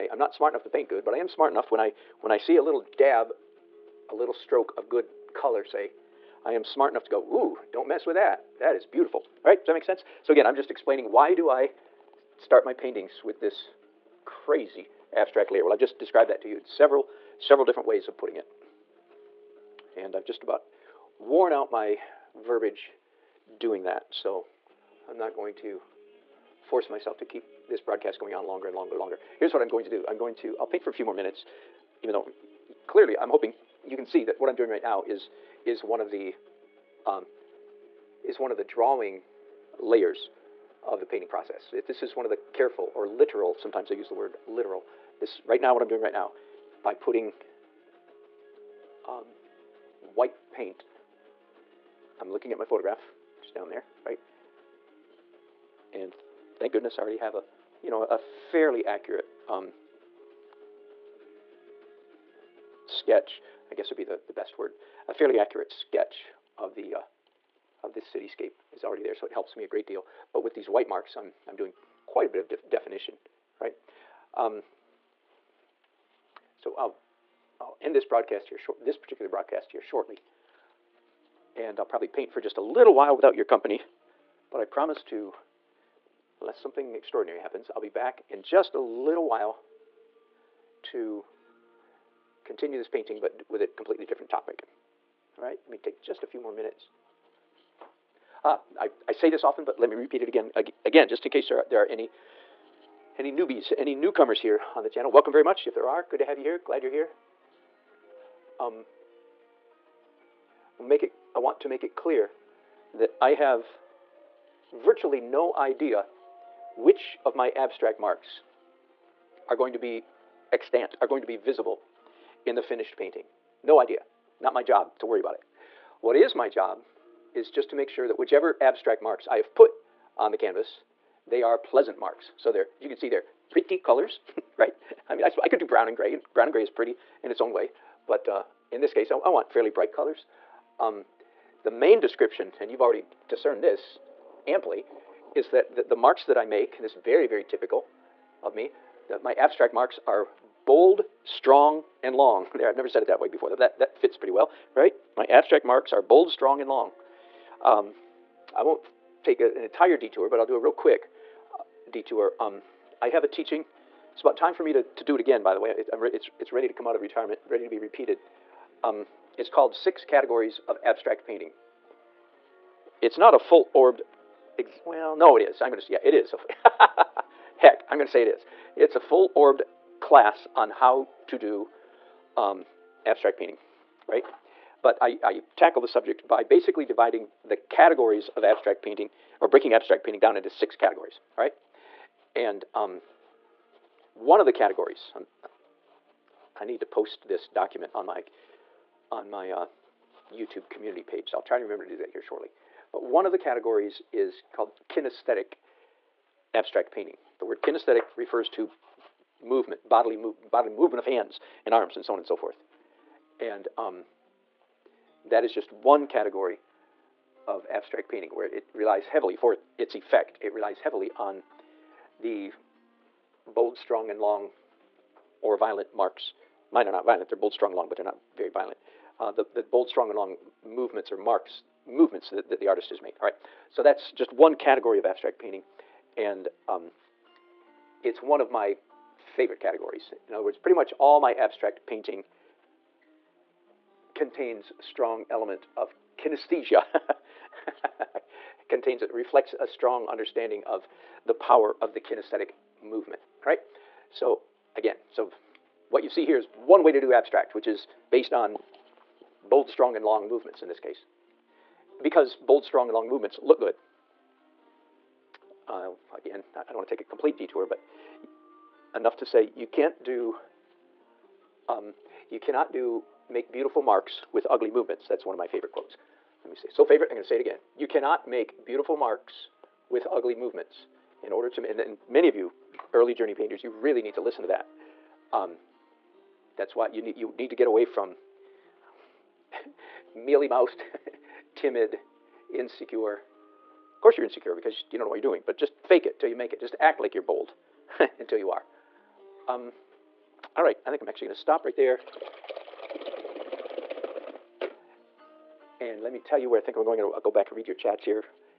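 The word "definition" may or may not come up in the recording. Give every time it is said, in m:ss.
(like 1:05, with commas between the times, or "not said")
1:12.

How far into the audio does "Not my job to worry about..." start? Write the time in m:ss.
2:04.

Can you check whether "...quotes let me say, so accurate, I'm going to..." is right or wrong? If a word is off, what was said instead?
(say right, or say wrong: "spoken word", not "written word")
wrong: "favorite", not "accurate".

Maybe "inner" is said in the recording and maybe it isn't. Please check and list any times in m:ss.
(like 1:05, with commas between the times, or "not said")
not said.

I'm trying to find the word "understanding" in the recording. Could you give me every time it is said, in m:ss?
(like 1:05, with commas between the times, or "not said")
4:10.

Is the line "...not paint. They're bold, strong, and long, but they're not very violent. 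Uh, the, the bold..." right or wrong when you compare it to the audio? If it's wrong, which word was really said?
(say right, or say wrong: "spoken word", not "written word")
wrong: "violent", not "paint".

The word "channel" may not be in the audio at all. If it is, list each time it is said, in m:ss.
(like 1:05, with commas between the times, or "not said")
1:44.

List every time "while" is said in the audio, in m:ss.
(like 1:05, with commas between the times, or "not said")
1:22, 1:29.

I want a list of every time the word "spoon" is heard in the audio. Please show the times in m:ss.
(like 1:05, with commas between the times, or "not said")
not said.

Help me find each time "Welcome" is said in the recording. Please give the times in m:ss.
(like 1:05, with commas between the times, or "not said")
1:45.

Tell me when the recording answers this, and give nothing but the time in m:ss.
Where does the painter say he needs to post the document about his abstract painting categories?
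3:20.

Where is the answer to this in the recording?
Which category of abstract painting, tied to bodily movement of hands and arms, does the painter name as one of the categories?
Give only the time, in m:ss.
3:24.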